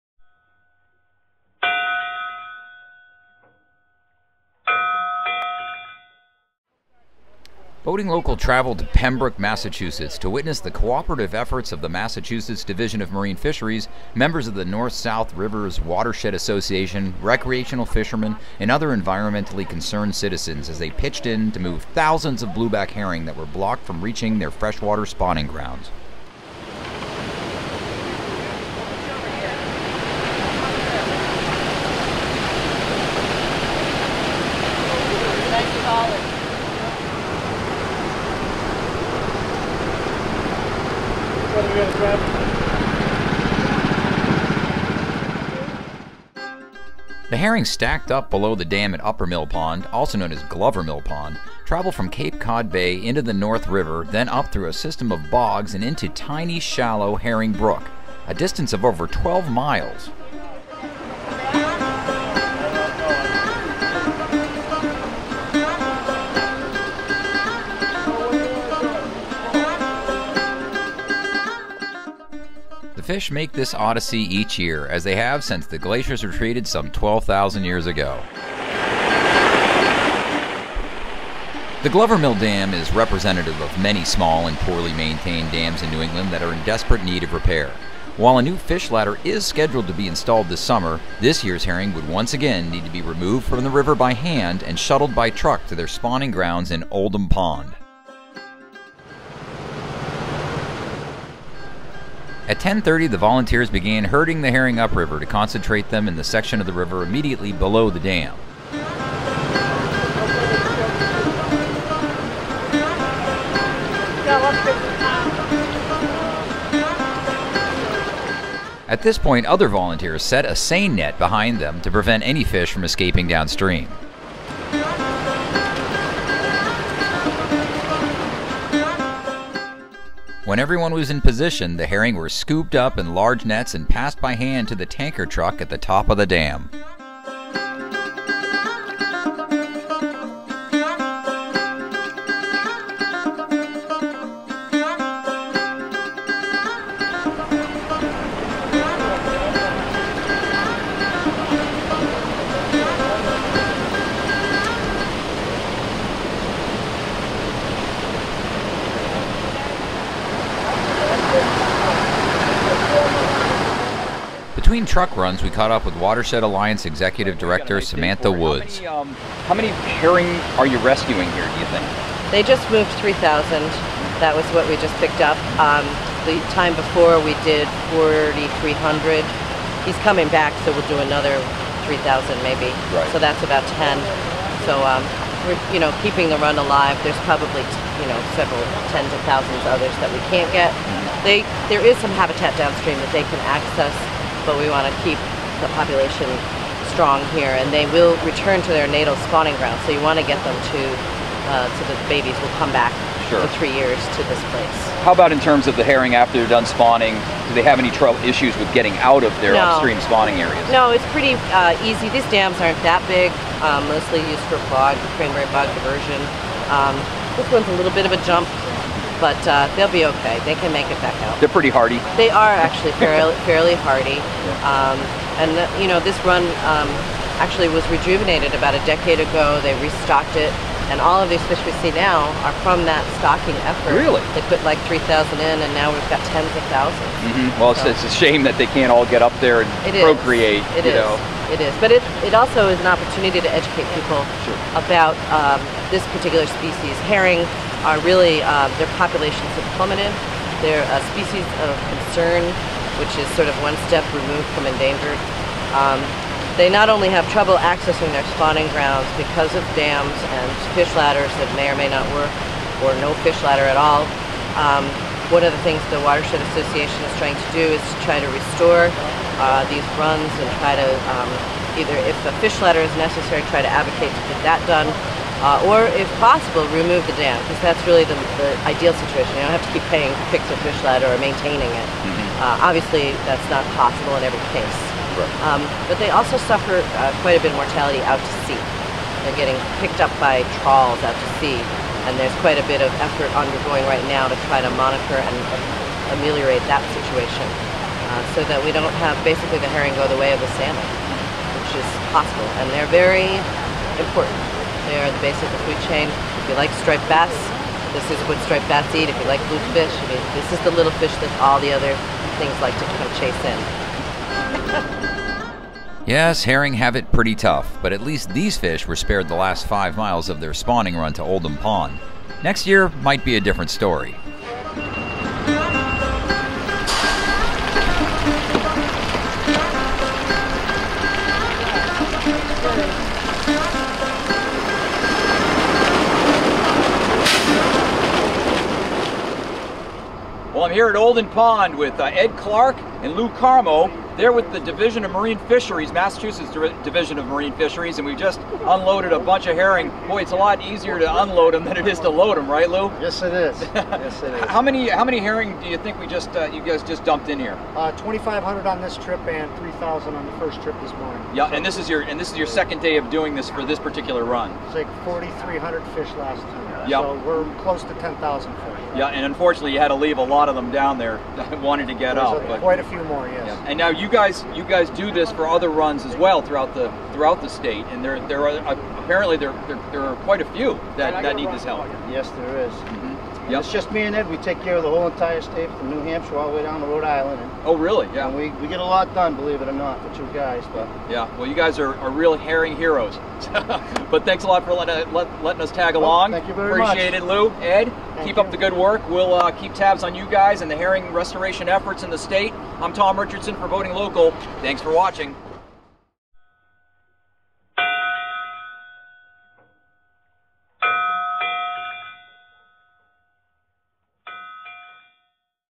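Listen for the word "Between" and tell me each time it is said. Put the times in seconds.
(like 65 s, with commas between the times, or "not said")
164 s.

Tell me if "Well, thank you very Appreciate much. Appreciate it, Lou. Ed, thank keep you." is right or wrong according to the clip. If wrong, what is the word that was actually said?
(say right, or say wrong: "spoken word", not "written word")
right.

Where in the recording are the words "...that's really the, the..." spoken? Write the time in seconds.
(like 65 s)
277 s.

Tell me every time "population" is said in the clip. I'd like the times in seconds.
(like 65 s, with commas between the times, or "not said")
195 s, 249 s.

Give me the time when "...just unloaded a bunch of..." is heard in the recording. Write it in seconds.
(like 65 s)
348 s.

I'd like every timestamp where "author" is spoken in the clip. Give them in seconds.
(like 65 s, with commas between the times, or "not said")
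not said.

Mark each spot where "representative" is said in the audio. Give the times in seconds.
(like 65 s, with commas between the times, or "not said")
82 s.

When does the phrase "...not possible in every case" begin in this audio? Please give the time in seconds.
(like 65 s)
283 s.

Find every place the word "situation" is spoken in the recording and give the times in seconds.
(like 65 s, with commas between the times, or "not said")
279 s, 296 s.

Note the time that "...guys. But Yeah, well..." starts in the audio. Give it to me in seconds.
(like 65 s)
390 s.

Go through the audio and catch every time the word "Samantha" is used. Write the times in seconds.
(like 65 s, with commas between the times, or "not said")
167 s.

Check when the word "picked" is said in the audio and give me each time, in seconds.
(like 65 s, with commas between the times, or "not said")
175 s, 289 s.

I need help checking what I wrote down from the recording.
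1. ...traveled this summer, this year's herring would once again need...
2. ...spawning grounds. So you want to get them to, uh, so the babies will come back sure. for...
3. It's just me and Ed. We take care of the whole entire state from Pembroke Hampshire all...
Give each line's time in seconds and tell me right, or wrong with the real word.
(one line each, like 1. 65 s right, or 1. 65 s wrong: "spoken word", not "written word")
1. 90 s wrong: "installed", not "traveled"
2. 199 s right
3. 383 s wrong: "New", not "Pembroke".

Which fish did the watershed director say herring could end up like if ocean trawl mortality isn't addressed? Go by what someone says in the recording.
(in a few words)
salmon.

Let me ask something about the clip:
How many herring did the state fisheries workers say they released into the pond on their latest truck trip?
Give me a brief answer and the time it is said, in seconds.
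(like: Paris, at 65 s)
2,500, at 357 s.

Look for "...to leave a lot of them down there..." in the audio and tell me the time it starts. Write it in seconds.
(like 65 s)
369 s.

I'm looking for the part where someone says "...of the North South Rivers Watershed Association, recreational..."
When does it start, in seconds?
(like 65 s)
14 s.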